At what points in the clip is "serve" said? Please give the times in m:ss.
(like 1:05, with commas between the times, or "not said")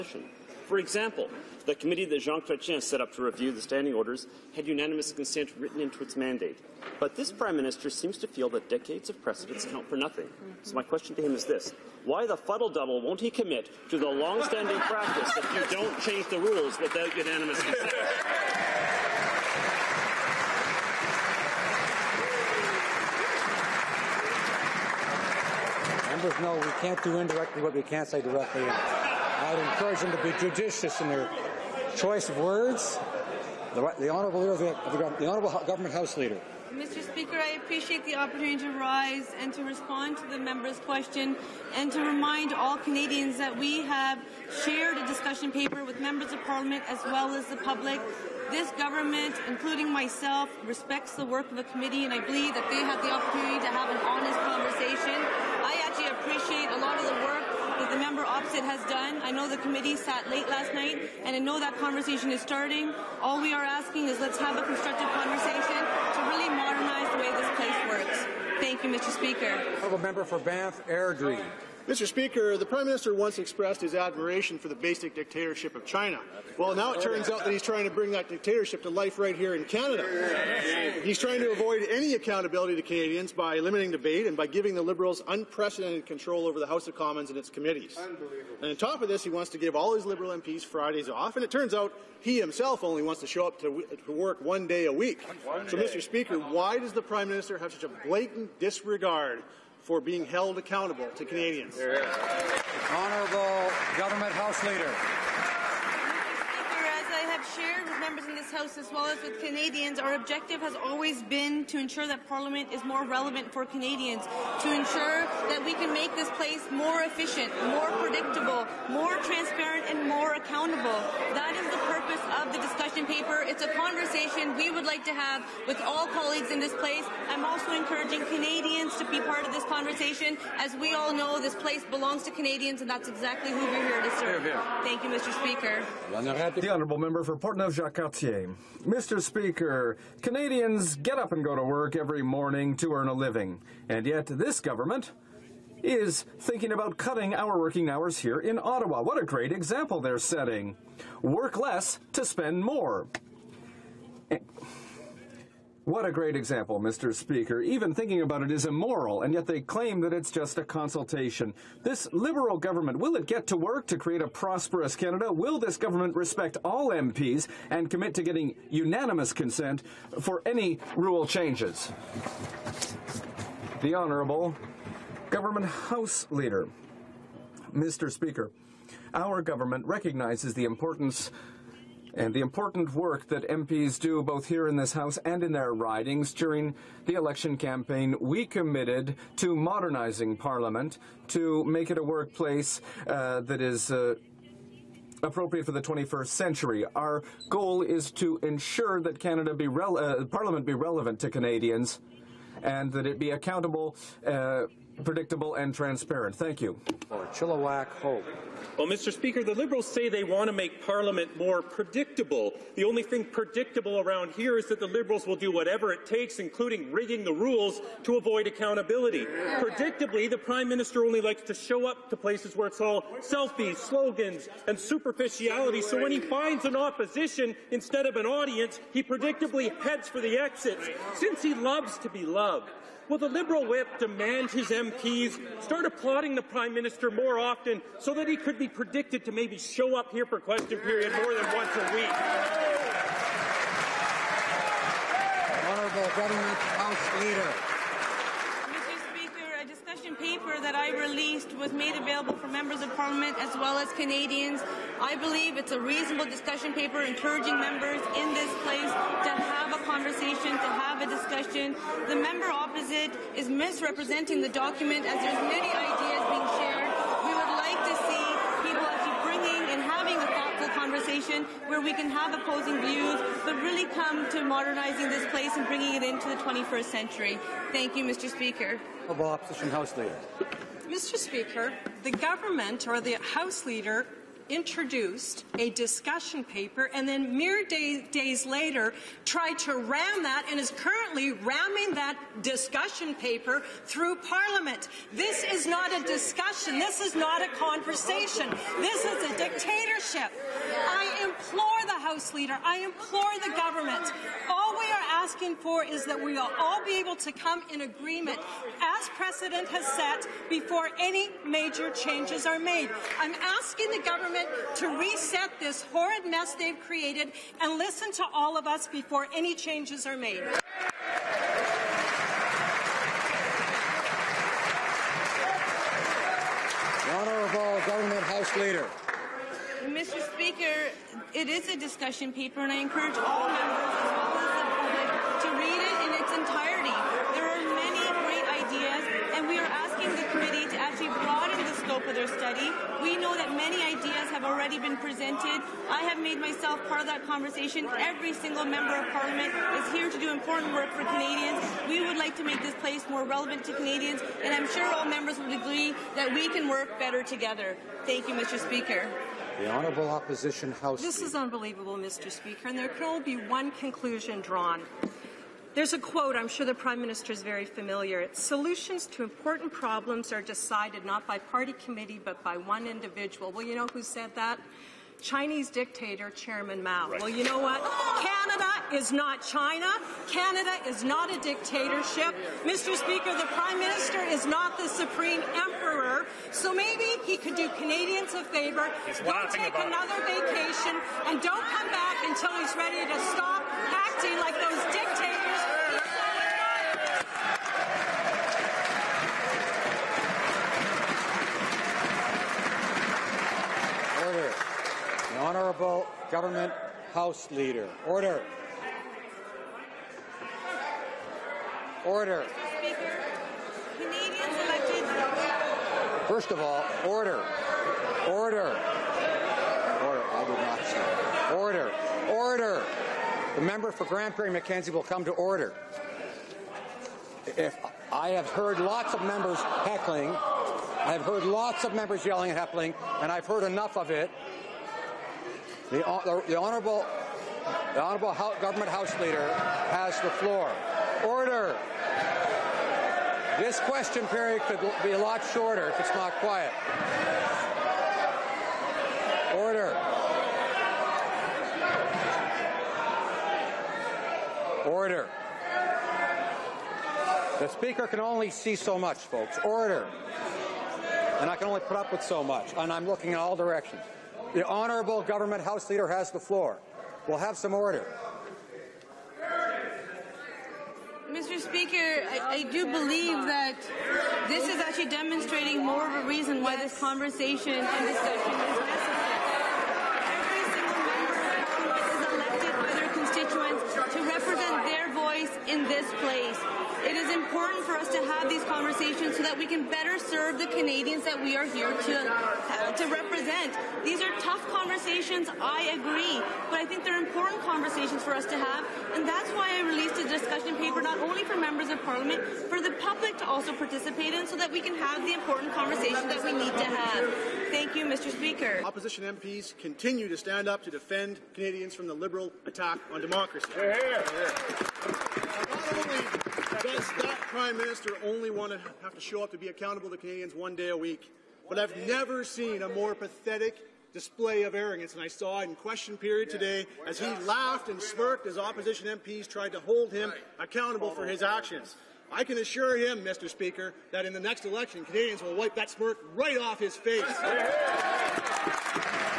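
2:14, 8:10.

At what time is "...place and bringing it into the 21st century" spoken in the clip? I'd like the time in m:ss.
4:35.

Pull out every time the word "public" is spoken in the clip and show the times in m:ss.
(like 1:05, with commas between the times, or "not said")
0:47, 8:22.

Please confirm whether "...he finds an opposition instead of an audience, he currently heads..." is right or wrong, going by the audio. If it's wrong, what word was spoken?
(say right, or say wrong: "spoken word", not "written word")
wrong: "predictably", not "currently".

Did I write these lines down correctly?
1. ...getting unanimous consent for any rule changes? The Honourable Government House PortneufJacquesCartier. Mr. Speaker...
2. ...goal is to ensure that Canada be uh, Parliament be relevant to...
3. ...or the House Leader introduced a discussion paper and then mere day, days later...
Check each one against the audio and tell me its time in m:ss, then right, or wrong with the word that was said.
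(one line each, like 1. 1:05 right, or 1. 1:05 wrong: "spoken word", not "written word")
1. 2:48 wrong: "Leader", not "PortneufJacquesCartier"
2. 3:17 right
3. 4:42 right.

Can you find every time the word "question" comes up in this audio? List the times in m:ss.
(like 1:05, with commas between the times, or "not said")
0:10, 0:40, 4:00, 4:21, 7:23, 8:45.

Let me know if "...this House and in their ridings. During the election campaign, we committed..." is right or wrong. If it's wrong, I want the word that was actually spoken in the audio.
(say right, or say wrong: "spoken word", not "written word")
right.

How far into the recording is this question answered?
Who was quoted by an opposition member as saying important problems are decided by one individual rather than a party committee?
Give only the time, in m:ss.
6:16.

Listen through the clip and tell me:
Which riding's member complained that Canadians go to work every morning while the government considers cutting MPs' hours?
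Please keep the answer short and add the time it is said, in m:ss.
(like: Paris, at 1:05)
Portneuf-Jacques-Cartier, at 2:17.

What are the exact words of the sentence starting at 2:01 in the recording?
That is the purpose of the discussion paper.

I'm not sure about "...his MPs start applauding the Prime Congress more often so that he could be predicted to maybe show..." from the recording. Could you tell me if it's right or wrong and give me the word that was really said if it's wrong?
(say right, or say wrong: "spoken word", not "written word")
wrong: "Minister", not "Congress".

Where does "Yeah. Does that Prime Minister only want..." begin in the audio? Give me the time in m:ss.
8:34.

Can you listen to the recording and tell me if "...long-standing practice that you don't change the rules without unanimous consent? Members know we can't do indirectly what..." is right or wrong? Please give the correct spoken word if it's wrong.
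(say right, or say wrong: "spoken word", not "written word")
right.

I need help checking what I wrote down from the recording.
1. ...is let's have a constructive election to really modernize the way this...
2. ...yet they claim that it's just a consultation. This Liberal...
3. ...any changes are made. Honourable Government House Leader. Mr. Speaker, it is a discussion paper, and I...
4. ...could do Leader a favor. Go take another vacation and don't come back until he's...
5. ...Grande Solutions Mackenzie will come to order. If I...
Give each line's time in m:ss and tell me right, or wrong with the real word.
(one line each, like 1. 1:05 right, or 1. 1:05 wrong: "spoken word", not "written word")
1. 1:04 wrong: "conversation", not "election"
2. 2:39 right
3. 5:19 right
4. 6:27 wrong: "Canadians", not "Leader"
5. 7:04 wrong: "Prairie", not "Solutions".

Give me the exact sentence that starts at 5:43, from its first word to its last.
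We know that many ideas have already been presented.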